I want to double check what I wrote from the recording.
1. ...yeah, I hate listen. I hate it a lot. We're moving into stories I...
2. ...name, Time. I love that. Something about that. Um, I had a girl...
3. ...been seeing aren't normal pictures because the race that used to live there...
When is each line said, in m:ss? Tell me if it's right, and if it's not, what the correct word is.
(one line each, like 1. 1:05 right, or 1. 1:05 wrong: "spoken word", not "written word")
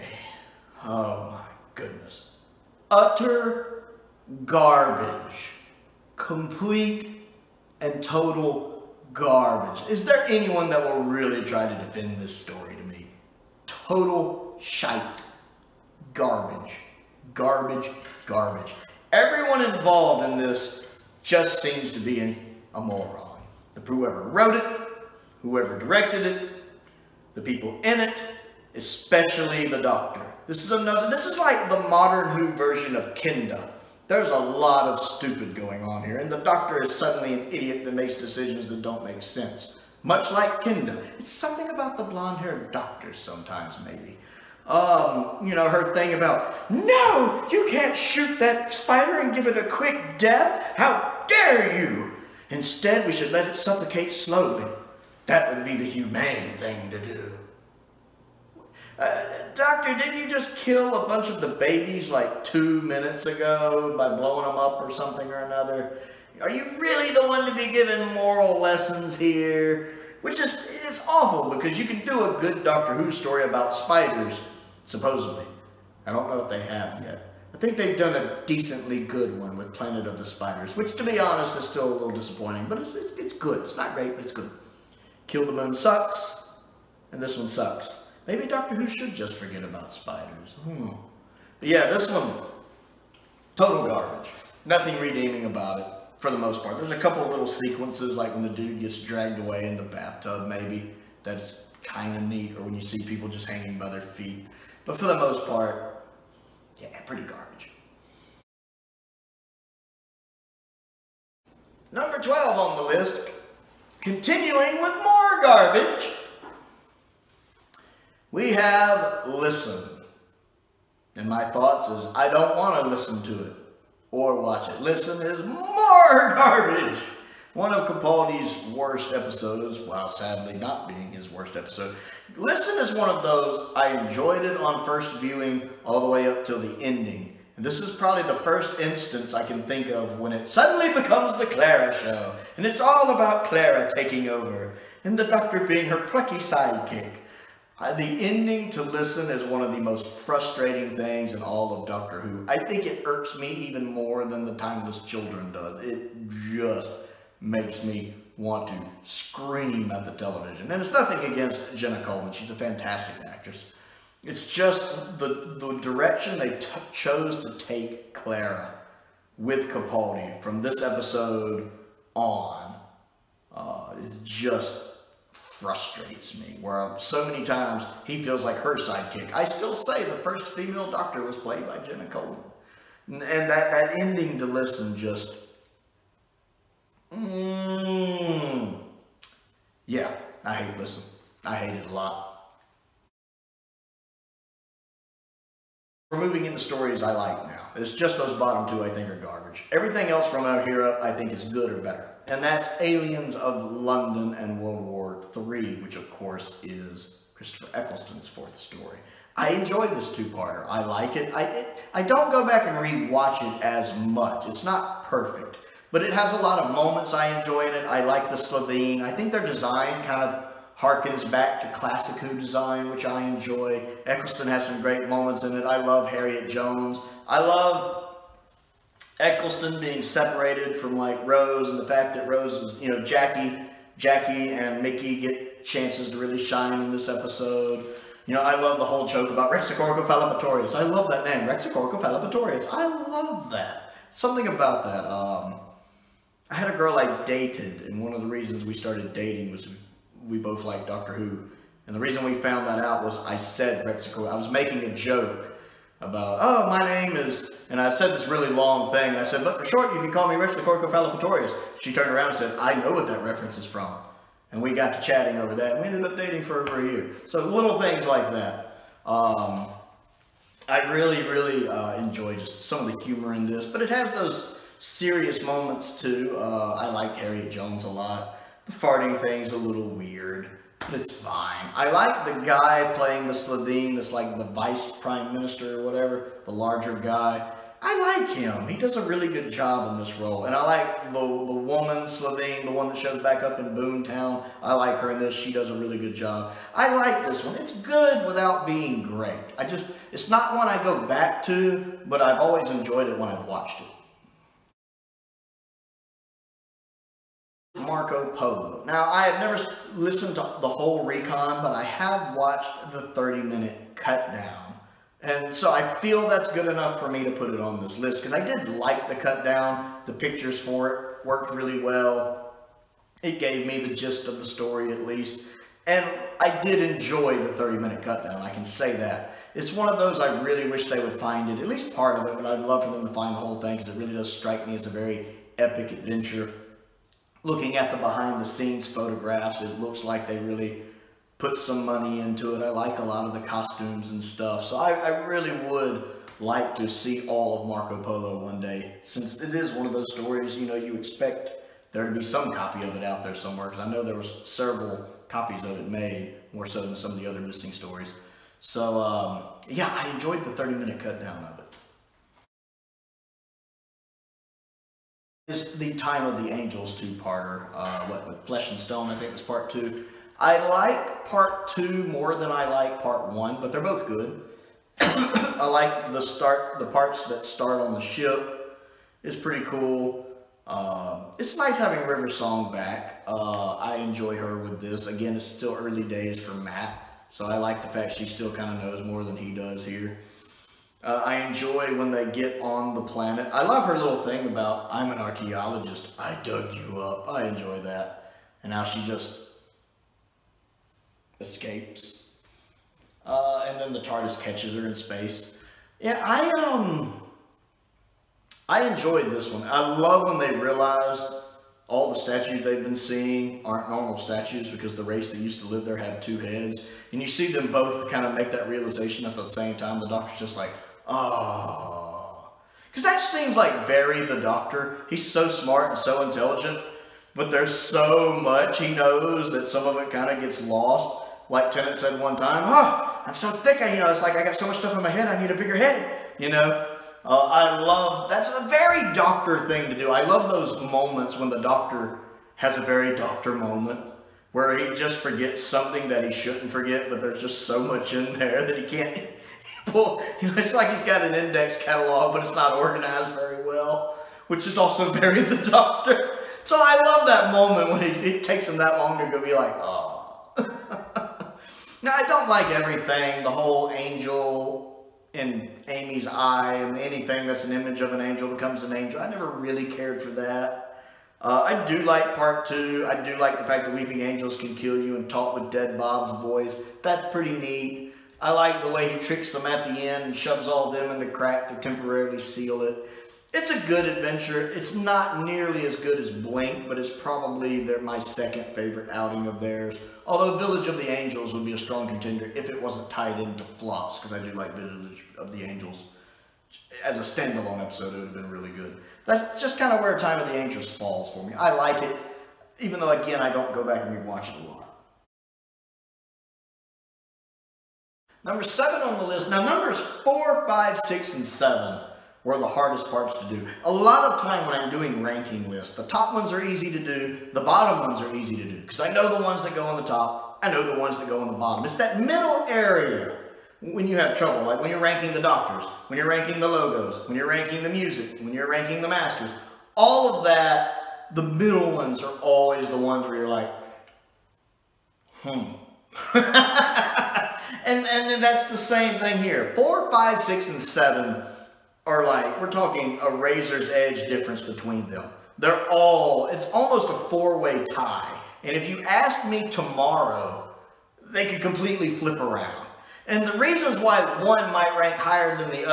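1. 3:09 right
2. 4:01 wrong: "Raxacoricofallapatorius", not "Time"
3. 6:52 wrong: "statues", not "pictures".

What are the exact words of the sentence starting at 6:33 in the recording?
I love her little thing about, I'm an archaeologist, I dug you up.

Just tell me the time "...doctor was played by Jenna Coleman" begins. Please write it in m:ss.
3:00.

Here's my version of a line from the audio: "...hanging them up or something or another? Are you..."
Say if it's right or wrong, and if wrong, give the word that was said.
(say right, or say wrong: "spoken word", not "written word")
wrong: "blowing", not "hanging".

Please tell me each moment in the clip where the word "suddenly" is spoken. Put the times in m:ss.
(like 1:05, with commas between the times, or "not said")
0:36, 2:20.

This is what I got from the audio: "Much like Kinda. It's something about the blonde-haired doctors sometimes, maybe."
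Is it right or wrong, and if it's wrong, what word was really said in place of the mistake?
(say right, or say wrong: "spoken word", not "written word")
right.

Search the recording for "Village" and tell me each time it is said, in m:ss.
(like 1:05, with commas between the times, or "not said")
8:10, 8:14.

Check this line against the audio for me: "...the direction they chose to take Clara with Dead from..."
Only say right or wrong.
wrong.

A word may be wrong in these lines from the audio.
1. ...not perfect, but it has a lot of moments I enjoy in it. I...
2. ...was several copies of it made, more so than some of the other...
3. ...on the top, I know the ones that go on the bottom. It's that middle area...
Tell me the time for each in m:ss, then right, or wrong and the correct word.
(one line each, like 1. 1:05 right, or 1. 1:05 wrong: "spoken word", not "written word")
1. 3:34 right
2. 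5:54 right
3. 8:39 right.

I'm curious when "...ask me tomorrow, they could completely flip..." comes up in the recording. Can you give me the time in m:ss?
9:09.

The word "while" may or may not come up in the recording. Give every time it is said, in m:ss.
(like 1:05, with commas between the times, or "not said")
2:09.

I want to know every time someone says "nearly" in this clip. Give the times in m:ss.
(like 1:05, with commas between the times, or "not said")
8:05.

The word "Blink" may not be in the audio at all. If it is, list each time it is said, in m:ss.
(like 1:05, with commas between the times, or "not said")
8:06.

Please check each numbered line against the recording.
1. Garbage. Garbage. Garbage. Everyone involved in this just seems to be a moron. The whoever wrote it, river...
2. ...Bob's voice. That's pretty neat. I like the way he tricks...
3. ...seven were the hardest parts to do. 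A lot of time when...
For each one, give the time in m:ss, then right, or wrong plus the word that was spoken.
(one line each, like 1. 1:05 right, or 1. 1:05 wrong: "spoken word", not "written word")
1. 0:16 wrong: "whoever", not "river"
2. 7:55 right
3. 8:31 right.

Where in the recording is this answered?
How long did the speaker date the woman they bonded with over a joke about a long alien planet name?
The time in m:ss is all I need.
4:26.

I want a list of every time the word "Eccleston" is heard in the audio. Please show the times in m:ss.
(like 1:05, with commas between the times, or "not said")
3:27, 3:44, 3:49.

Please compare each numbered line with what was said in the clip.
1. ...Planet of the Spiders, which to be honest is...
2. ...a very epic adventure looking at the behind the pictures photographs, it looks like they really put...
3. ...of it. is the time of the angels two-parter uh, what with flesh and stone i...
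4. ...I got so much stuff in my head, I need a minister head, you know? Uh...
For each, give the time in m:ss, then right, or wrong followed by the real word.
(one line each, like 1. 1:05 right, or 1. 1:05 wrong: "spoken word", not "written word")
1. 1:19 right
2. 5:34 wrong: "scenes", not "pictures"
3. 6:01 right
4. 7:14 wrong: "bigger", not "minister".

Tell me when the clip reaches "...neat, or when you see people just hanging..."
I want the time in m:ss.
1:42.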